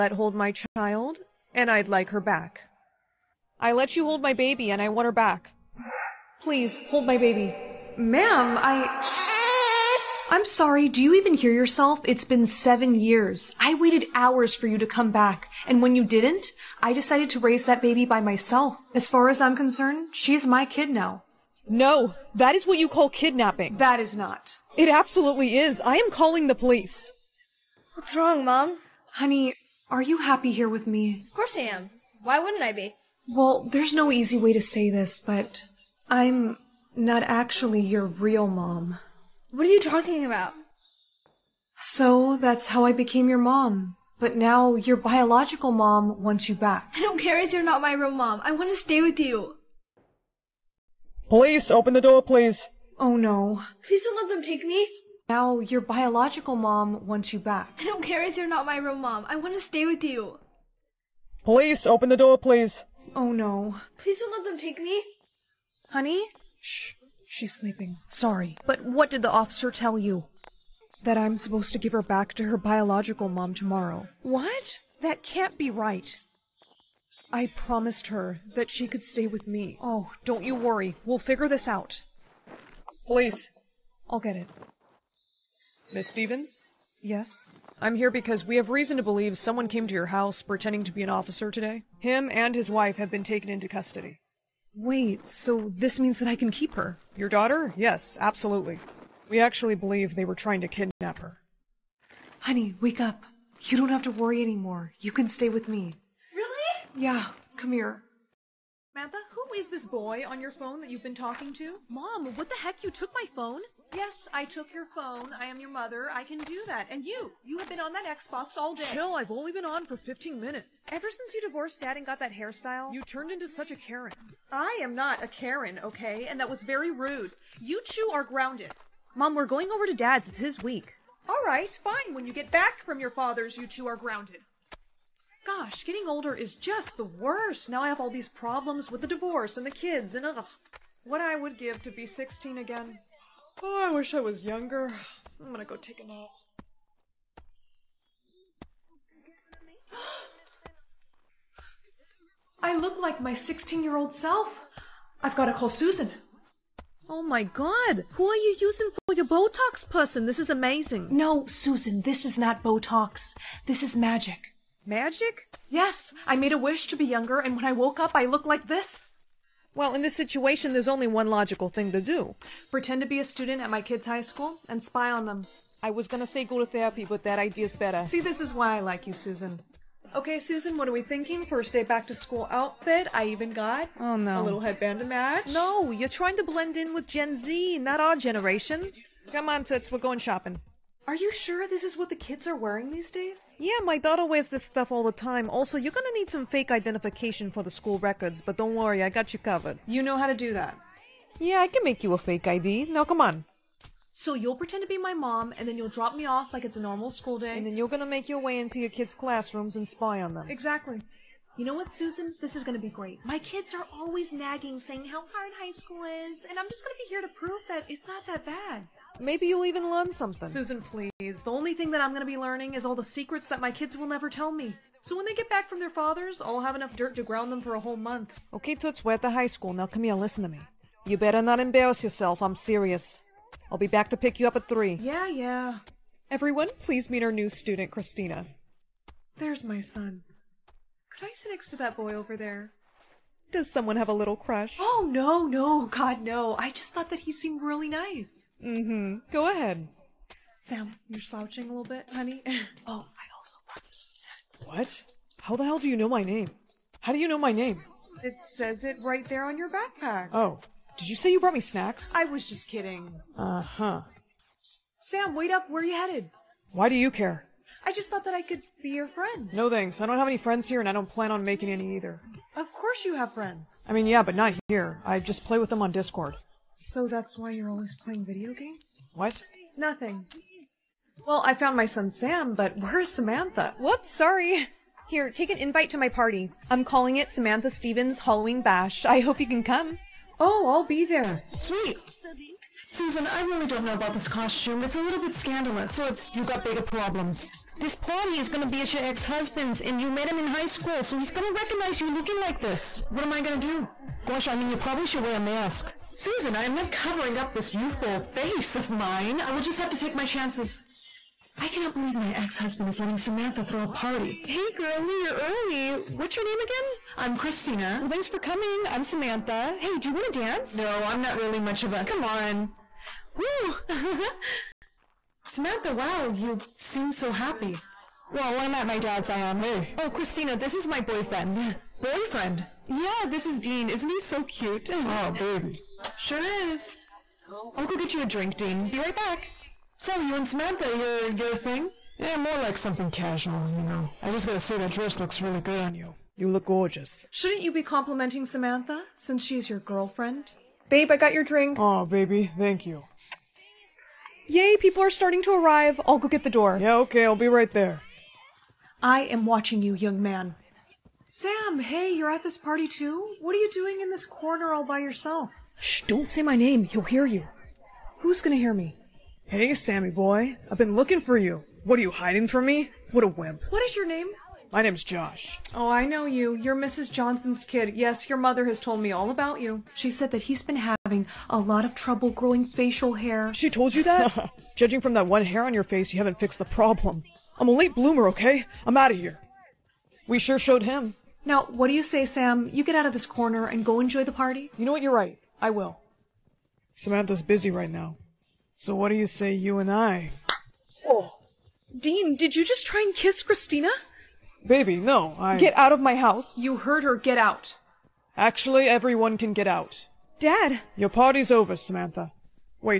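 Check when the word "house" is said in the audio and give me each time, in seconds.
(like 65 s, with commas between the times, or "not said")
90 s, 406 s.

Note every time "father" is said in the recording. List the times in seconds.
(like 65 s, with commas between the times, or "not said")
133 s, 225 s.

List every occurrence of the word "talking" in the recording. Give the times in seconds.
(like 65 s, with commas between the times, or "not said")
39 s, 111 s.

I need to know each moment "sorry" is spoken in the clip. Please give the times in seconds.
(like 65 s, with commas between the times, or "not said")
10 s, 68 s, 284 s.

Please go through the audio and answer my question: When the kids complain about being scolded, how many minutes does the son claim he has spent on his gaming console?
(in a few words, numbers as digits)
15.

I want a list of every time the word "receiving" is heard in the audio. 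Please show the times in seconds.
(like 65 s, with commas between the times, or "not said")
not said.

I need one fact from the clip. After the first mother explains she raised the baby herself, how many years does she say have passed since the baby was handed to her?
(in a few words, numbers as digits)
7.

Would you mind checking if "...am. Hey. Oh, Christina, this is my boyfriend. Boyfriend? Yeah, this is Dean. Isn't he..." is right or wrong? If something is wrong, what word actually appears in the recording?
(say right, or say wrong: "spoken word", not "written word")
right.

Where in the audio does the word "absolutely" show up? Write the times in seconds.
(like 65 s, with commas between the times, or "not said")
24 s, 98 s.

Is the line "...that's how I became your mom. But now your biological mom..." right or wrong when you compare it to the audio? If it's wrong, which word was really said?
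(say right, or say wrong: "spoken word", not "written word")
right.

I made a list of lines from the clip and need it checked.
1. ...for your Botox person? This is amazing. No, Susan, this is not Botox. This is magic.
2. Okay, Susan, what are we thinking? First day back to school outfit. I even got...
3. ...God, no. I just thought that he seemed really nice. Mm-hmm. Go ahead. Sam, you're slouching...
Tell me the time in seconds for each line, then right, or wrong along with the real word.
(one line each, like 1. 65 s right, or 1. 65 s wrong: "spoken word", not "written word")
1. 159 s right
2. 180 s right
3. 245 s right.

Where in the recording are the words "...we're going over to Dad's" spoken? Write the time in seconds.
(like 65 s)
129 s.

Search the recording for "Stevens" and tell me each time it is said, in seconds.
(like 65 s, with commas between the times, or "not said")
86 s, 287 s.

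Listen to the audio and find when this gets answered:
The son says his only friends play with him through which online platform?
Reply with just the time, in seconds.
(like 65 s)
275 s.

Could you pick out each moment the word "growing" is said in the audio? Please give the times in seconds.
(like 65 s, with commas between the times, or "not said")
382 s.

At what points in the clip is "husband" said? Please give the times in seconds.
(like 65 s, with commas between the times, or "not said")
299 s, 312 s.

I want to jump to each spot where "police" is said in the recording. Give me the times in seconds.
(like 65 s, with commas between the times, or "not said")
26 s, 51 s, 61 s, 83 s.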